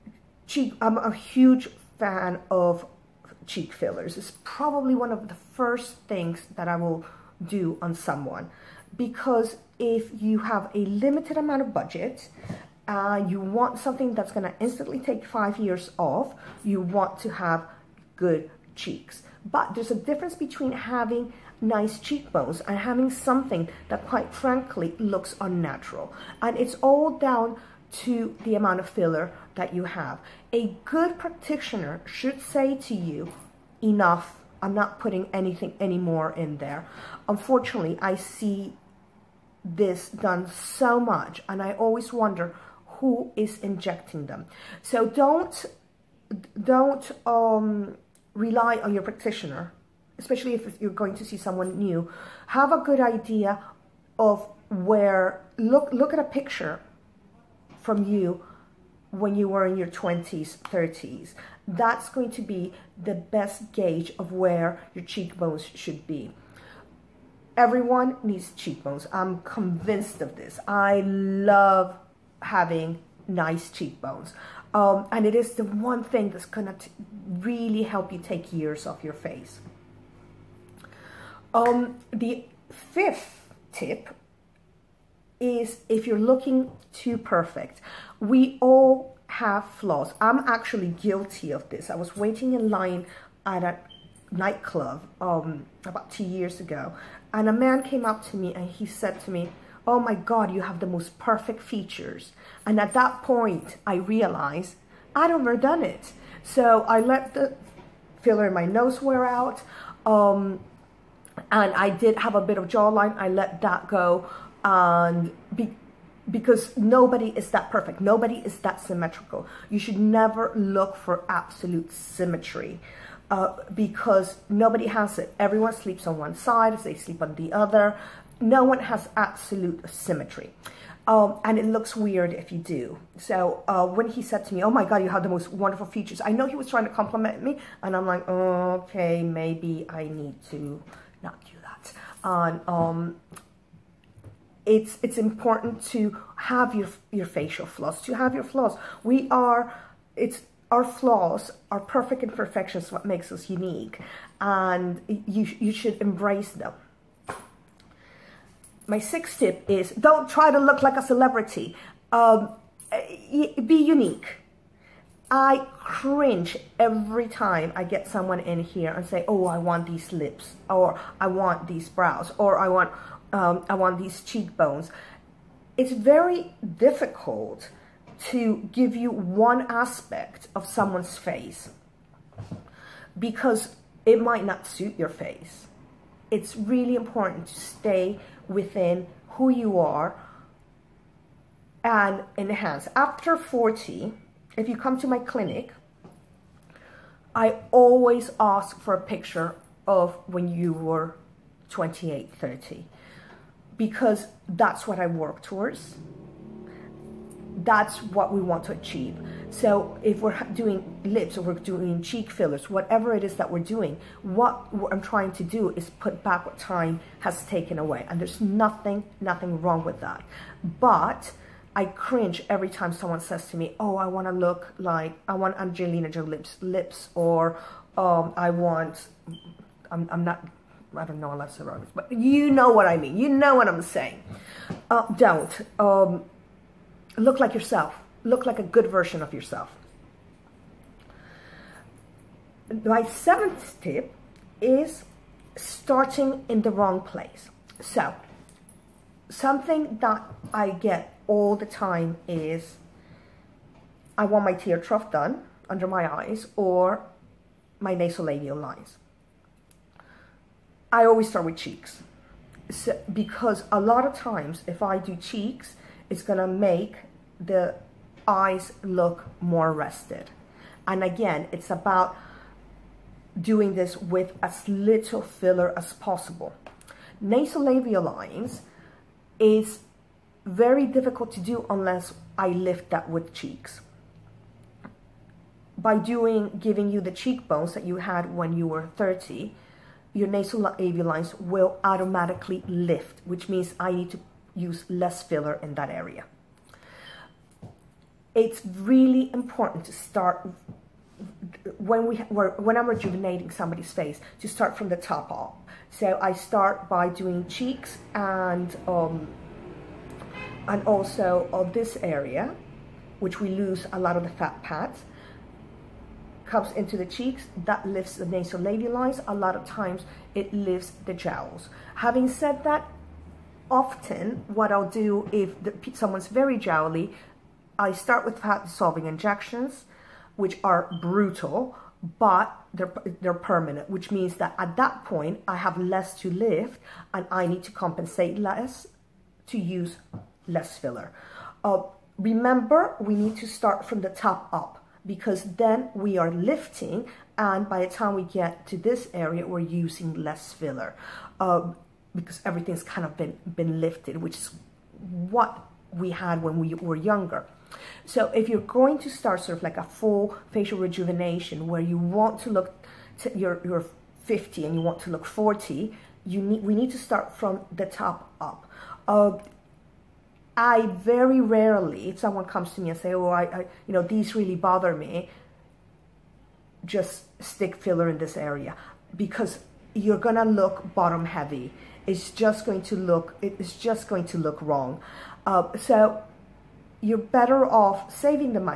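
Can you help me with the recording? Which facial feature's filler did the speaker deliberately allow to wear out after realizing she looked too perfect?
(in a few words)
Nose.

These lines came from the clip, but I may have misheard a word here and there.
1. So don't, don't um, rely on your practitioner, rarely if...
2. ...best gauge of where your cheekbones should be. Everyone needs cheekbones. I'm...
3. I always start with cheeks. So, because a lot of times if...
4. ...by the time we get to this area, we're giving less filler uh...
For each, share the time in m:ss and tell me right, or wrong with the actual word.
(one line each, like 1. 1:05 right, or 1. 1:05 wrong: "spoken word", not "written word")
1. 0:44 wrong: "especially", not "rarely"
2. 1:03 right
3. 4:20 right
4. 5:47 wrong: "using", not "giving".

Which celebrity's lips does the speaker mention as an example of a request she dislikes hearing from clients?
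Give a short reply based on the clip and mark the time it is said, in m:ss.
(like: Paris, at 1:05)
Angelina Jolie, at 3:45.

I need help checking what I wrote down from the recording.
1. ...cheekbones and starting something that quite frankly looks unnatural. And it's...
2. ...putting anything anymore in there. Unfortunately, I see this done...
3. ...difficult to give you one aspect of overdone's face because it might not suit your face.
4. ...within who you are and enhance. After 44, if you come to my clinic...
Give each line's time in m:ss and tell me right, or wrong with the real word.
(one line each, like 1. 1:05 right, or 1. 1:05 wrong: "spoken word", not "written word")
1. 0:21 wrong: "having", not "starting"
2. 0:35 right
3. 2:56 wrong: "someone", not "overdone"
4. 3:08 wrong: "40", not "44".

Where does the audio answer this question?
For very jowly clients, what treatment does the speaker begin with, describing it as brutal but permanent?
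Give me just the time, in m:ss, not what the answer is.
5:28.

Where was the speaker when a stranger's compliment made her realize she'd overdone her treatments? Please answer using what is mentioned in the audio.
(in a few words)
In line at a nightclub.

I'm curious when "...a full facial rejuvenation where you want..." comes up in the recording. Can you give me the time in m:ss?
5:59.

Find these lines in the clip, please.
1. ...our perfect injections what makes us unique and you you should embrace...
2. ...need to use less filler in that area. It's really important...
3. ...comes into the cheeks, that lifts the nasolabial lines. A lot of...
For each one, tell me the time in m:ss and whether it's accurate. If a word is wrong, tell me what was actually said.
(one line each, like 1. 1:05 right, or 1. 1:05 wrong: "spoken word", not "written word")
1. 2:31 wrong: "imperfections", not "injections"
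2. 4:53 right
3. 5:16 right.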